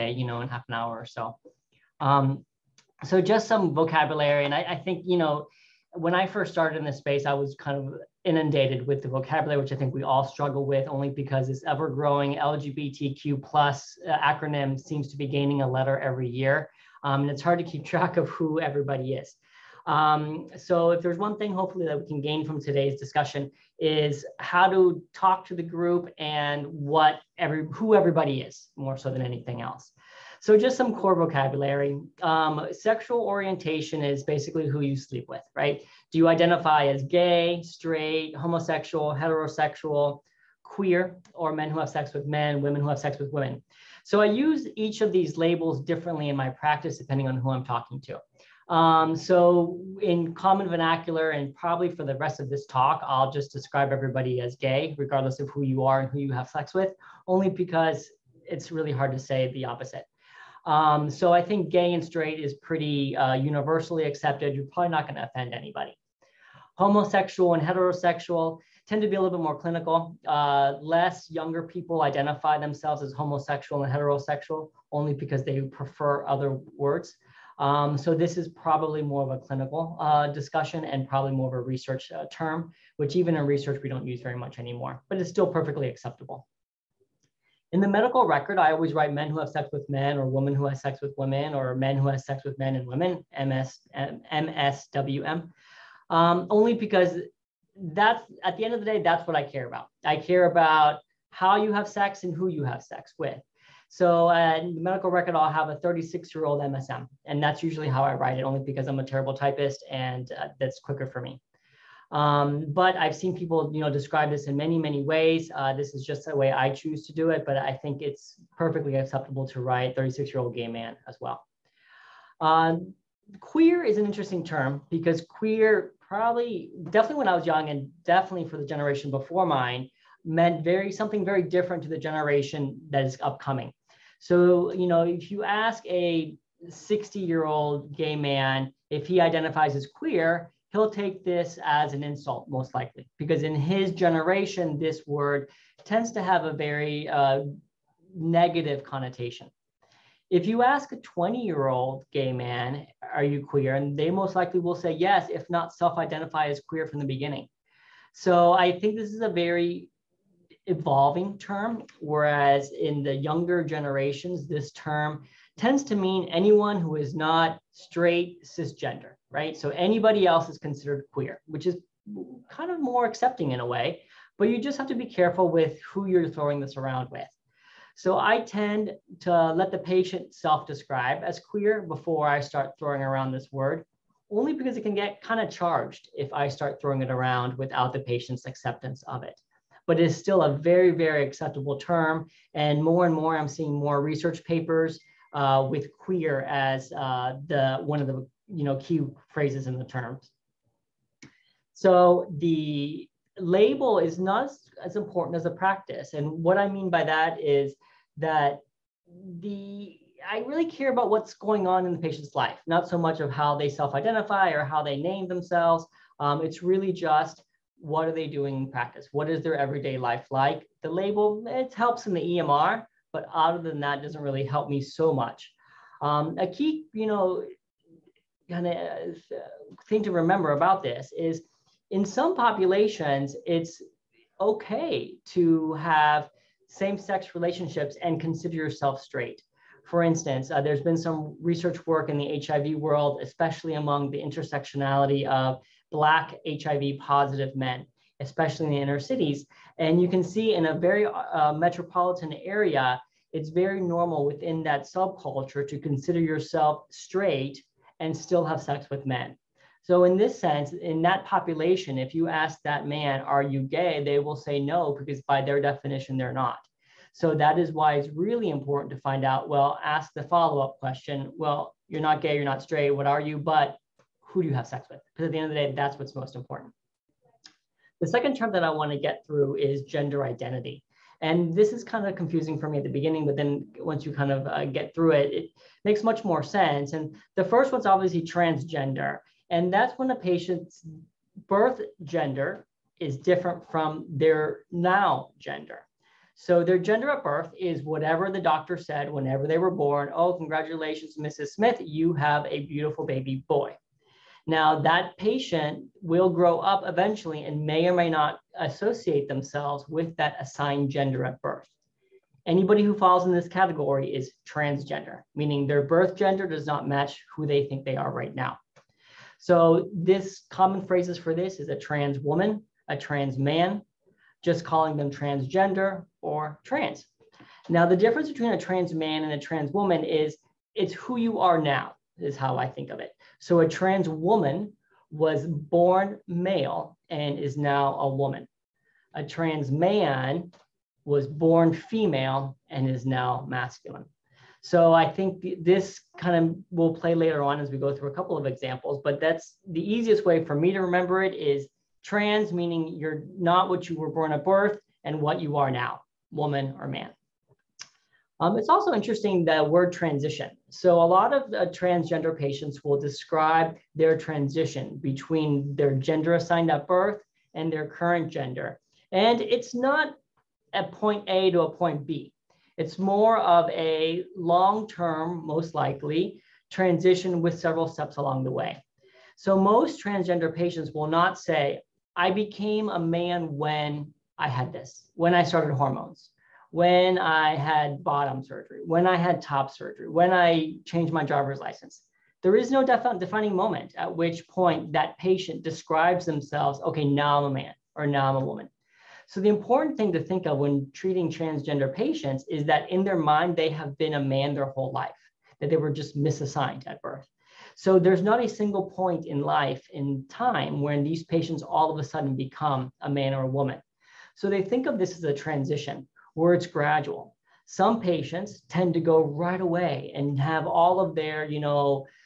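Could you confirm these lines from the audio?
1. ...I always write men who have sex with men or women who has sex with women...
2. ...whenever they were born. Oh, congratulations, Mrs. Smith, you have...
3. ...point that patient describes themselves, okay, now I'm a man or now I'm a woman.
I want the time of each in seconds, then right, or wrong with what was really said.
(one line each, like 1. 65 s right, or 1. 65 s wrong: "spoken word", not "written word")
1. 88 s right
2. 299 s right
3. 394 s right.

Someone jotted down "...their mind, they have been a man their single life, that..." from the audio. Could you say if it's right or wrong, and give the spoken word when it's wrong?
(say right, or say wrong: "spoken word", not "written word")
wrong: "whole", not "single".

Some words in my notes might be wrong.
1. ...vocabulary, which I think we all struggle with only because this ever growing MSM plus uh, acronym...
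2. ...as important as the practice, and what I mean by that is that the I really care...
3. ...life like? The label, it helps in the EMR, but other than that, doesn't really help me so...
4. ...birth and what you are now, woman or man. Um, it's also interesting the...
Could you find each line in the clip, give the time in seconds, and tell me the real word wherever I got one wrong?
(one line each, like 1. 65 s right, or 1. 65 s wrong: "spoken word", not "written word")
1. 9 s wrong: "LGBTQ", not "MSM"
2. 204 s right
3. 219 s right
4. 354 s right.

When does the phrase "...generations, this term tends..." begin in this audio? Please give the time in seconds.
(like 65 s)
163 s.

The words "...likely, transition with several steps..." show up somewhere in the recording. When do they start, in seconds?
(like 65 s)
375 s.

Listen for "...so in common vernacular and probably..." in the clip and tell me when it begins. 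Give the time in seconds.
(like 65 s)
49 s.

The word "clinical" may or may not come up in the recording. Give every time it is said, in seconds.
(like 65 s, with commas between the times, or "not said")
69 s, 79 s.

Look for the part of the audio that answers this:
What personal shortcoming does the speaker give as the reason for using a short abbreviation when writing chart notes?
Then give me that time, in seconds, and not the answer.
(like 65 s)
109 s.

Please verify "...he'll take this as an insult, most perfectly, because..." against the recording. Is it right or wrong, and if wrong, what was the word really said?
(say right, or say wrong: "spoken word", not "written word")
wrong: "likely", not "perfectly".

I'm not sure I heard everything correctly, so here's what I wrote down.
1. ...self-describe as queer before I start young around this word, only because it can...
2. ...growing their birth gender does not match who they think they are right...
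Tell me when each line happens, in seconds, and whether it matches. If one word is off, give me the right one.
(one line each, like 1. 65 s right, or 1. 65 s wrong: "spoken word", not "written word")
1. 180 s wrong: "throwing", not "young"
2. 315 s wrong: "meaning", not "growing".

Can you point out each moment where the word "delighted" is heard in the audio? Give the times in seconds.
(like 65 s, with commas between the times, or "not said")
not said.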